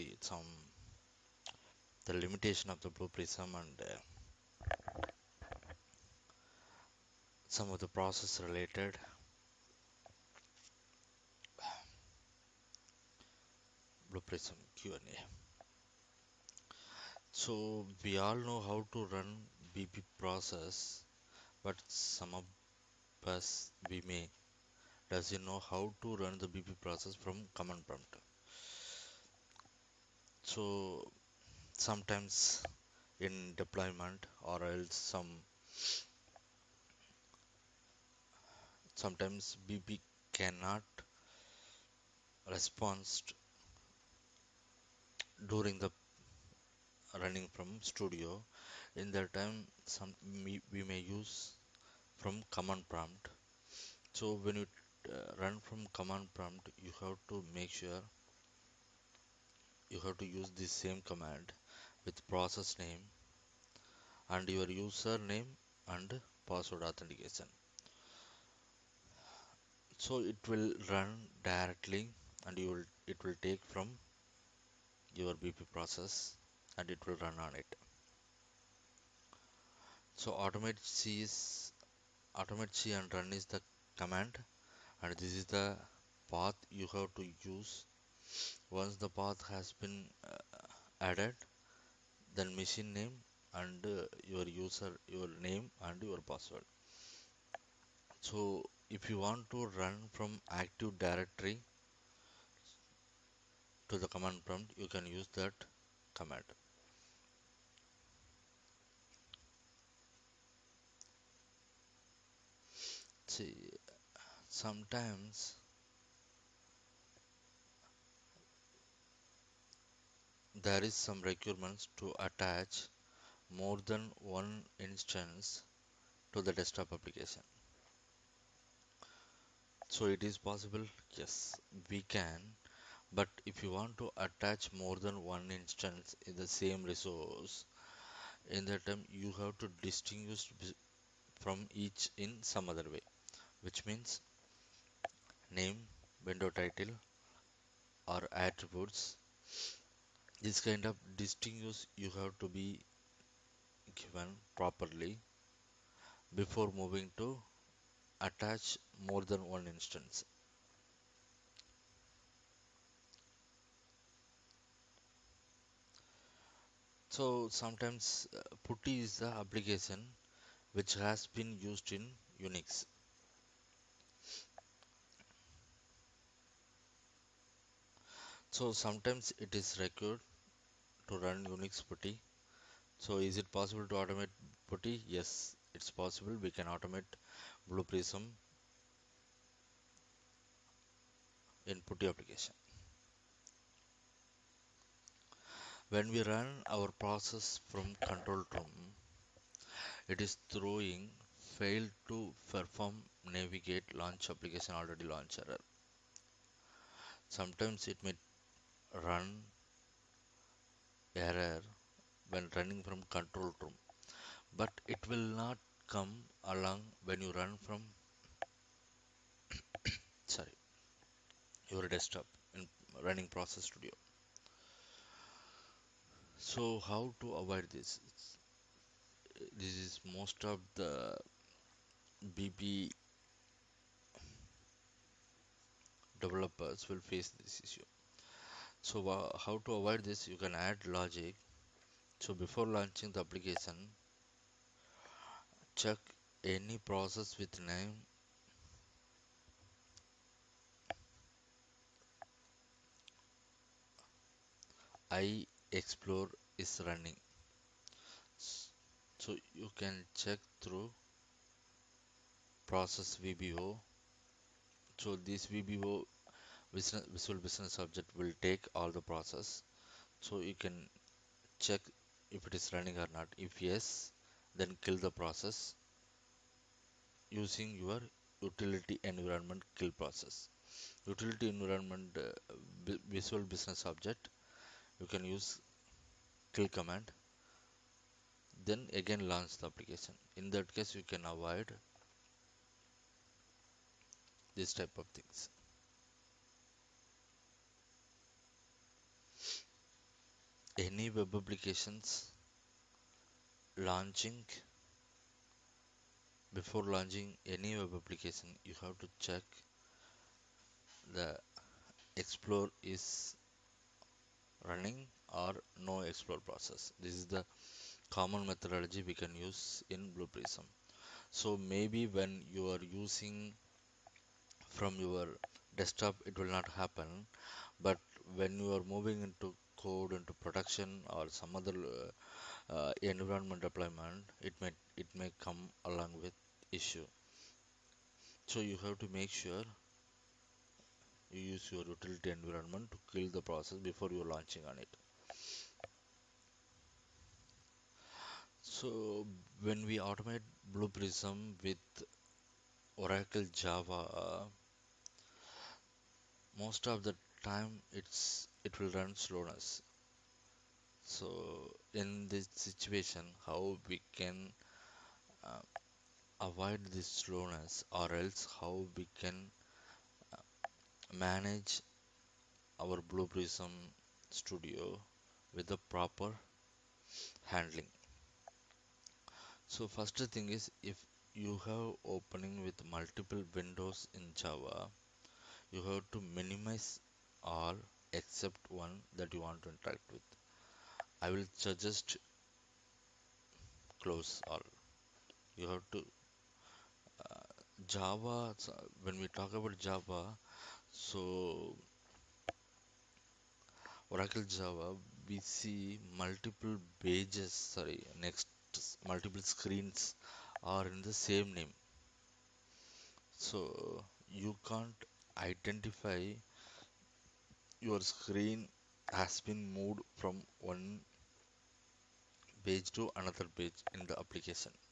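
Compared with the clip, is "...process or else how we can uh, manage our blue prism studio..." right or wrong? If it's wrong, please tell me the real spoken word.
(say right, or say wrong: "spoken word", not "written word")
wrong: "slowness", not "process".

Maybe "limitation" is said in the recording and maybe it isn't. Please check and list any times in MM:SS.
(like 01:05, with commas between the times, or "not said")
00:02.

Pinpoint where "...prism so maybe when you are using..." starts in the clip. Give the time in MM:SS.
05:20.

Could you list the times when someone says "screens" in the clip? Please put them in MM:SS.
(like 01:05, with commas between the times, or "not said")
06:49, 06:58.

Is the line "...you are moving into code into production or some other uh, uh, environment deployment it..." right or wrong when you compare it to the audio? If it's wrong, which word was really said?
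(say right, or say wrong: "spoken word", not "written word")
right.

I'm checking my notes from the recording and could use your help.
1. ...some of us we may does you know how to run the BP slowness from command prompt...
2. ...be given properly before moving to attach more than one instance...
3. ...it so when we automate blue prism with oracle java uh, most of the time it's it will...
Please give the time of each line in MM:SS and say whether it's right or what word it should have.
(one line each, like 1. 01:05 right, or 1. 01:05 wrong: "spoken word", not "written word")
1. 00:21 wrong: "process", not "slowness"
2. 02:32 right
3. 05:44 right.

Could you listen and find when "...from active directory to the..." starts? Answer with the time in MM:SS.
01:40.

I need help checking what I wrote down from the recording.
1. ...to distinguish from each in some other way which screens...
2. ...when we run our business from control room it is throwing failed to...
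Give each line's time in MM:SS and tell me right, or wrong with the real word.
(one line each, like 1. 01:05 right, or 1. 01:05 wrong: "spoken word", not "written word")
1. 02:19 wrong: "means", not "screens"
2. 03:15 wrong: "process", not "business".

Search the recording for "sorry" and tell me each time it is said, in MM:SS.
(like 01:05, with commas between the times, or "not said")
03:40, 06:47.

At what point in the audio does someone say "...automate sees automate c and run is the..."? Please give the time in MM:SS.
01:20.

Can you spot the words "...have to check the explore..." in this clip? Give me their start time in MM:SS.
05:08.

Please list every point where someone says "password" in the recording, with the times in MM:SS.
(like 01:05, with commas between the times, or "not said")
01:06, 01:36.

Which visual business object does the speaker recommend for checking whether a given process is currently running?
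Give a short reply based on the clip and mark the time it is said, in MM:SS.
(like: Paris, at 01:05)
Process VBO, at 04:22.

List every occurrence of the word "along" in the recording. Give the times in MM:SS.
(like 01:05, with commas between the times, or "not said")
03:36, 05:35.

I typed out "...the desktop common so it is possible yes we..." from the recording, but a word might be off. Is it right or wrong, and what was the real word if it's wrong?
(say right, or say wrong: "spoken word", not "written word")
wrong: "application", not "common".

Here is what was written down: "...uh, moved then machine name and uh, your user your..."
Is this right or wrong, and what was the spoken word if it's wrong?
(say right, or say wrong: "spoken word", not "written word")
wrong: "added", not "moved".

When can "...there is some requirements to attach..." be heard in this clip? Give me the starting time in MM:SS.
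02:00.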